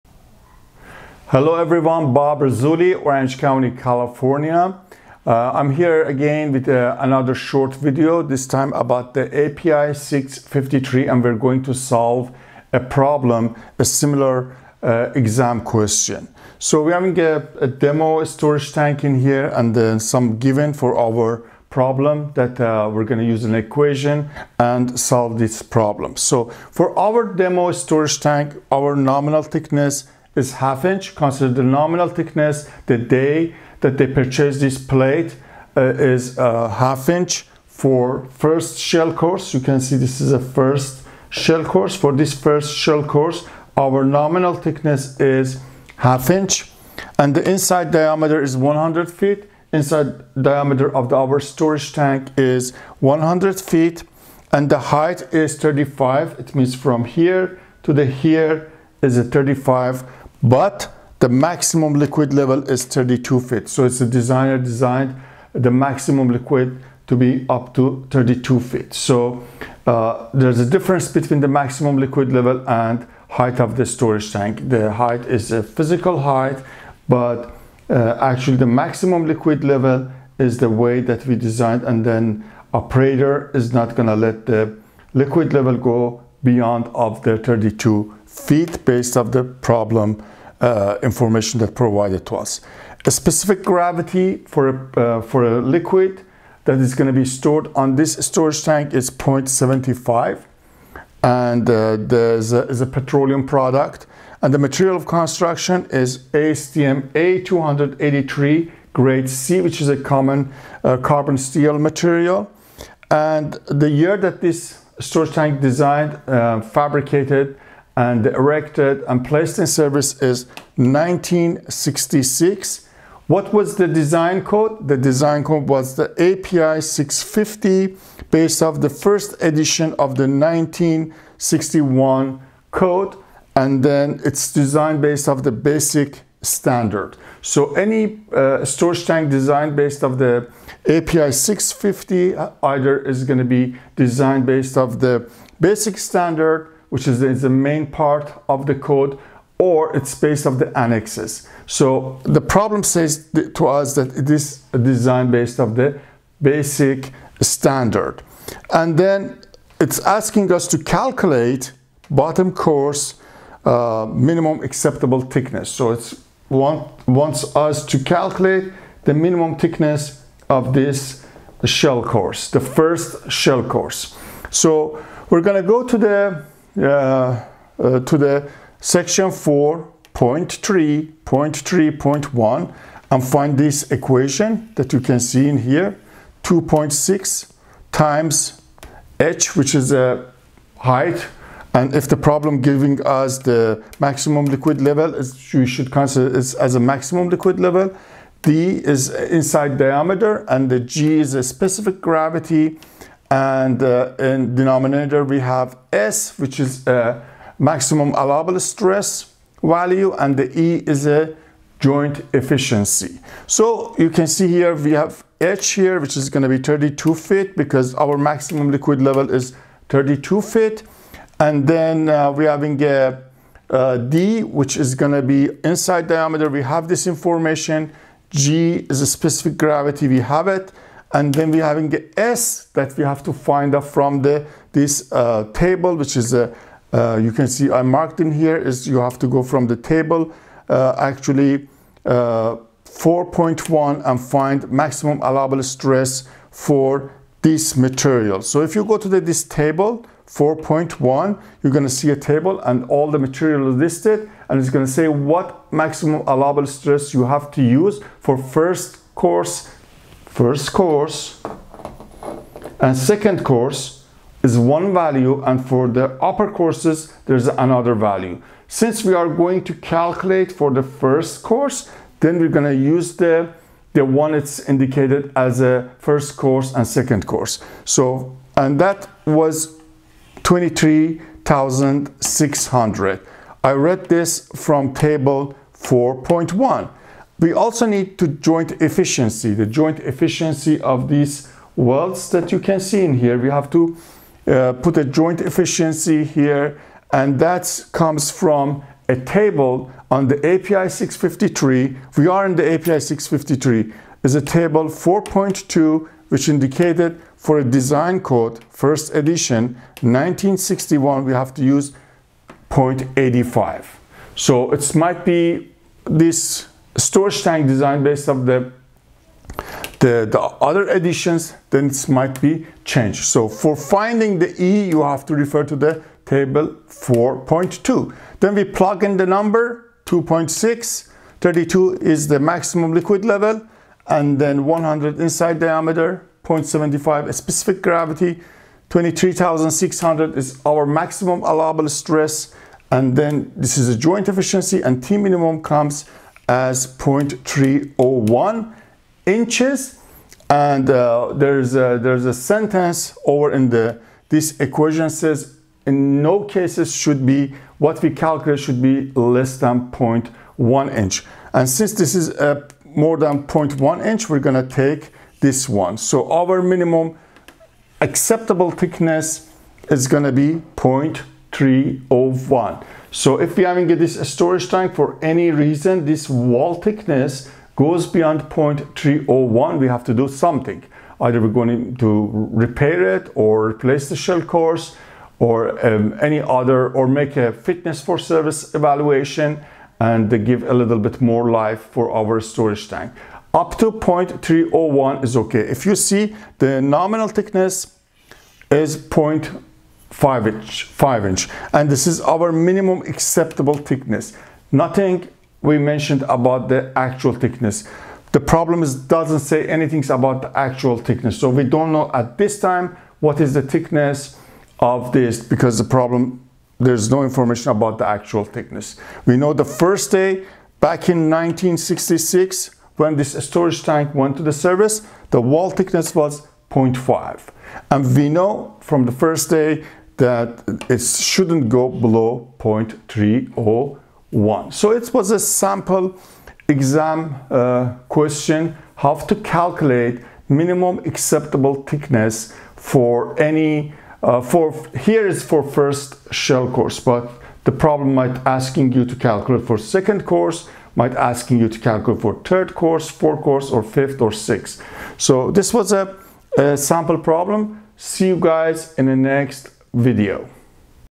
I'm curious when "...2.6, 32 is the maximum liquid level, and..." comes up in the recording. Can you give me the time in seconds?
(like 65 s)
330 s.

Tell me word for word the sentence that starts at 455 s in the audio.
So this was a, a sample problem.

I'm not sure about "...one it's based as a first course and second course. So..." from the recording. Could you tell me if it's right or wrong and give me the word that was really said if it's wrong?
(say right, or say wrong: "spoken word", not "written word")
wrong: "indicated", not "based".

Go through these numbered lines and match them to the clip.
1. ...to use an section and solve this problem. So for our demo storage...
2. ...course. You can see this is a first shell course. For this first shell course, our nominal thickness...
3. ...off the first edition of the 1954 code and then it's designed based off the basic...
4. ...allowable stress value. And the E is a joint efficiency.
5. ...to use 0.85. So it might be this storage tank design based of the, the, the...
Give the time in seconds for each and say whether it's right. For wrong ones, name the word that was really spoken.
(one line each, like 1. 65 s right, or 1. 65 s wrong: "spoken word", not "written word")
1. 23 s wrong: "equation", not "section"
2. 39 s right
3. 128 s wrong: "1961", not "1954"
4. 208 s right
5. 311 s right.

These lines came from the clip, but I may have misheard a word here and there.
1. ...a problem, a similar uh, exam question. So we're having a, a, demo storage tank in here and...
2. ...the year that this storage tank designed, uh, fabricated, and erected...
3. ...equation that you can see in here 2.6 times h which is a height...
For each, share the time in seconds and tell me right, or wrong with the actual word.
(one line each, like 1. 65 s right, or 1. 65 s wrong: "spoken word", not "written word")
1. 12 s right
2. 113 s right
3. 183 s right.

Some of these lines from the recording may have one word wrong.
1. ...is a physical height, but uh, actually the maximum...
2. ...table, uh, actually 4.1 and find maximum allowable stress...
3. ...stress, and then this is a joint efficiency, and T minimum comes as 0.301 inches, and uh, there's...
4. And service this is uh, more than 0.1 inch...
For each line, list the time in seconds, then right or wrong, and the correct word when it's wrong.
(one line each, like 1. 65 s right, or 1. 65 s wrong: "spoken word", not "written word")
1. 75 s right
2. 239 s right
3. 341 s right
4. 361 s wrong: "since", not "service".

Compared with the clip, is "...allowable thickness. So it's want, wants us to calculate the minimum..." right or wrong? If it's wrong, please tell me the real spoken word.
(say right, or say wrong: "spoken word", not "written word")
wrong: "acceptable", not "allowable".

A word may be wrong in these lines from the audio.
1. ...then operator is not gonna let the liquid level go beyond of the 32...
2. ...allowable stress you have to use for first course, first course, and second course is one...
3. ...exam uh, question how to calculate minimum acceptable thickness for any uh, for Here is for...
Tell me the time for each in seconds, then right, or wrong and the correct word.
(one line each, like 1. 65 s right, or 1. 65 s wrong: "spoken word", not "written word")
1. 82 s right
2. 256 s right
3. 436 s right.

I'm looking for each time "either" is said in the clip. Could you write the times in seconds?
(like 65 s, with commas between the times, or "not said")
142 s, 381 s.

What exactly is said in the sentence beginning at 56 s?
It means from here to the here is a 35 but the maximum liquid level is 32 feet.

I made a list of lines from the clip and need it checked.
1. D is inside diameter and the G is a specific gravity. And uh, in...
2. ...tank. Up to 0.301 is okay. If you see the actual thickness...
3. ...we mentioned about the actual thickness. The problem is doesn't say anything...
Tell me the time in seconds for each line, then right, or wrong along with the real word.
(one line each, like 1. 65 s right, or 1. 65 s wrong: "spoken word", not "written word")
1. 198 s right
2. 392 s wrong: "nominal", not "actual"
3. 405 s right.